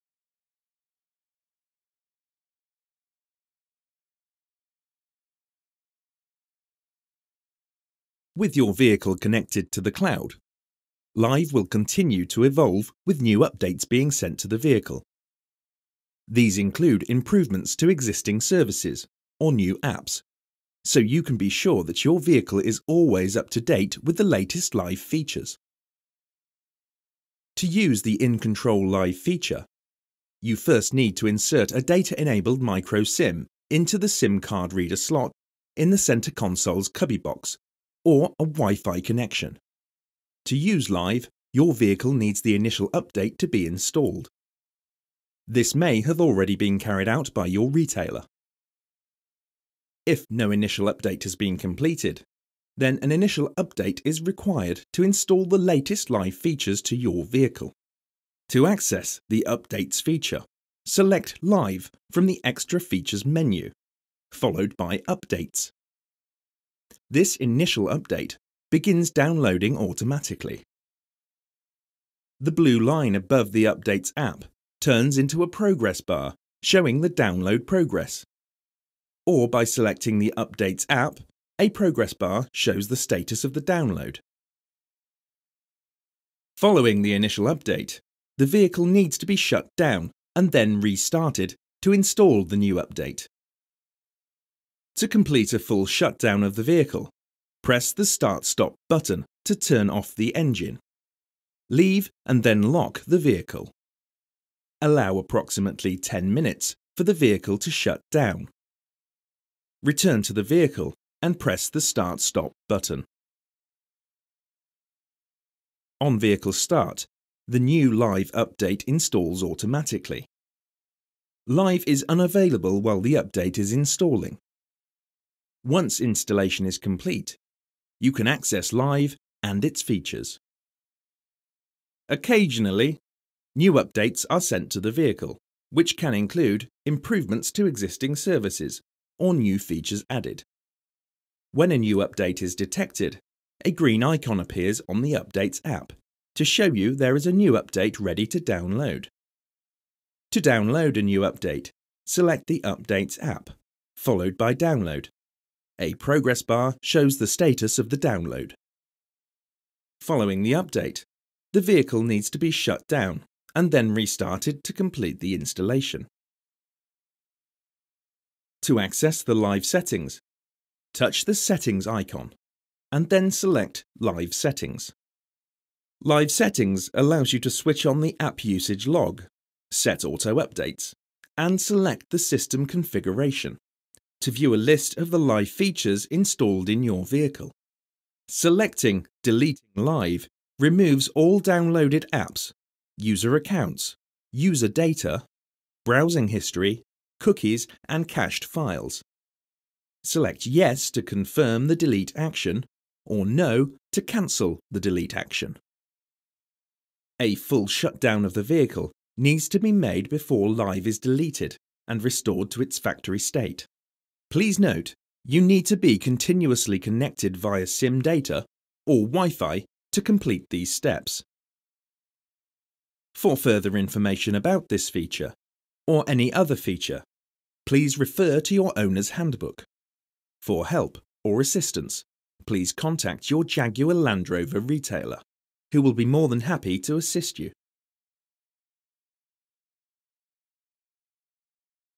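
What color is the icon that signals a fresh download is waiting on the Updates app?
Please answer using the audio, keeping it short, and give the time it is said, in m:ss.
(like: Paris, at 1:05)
Green, at 2:23.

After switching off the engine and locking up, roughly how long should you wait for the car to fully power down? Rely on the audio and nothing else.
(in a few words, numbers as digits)
10 minutes.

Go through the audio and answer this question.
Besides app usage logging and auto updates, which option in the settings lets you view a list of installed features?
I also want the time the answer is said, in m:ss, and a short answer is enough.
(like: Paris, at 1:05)
System configuration, at 3:02.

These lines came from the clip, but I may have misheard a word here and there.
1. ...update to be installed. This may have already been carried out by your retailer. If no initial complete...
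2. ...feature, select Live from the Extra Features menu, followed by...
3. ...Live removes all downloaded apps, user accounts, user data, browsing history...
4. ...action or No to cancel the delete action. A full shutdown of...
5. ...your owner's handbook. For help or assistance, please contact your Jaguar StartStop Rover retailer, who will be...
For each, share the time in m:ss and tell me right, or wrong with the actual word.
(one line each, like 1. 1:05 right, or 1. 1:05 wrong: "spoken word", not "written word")
1. 0:42 wrong: "update", not "complete"
2. 1:00 right
3. 3:09 right
4. 3:22 right
5. 3:48 wrong: "Land", not "StartStop".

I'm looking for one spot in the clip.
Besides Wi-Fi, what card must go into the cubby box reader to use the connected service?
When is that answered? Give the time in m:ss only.
0:31.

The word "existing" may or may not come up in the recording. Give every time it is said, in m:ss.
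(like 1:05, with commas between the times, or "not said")
0:17, 2:17.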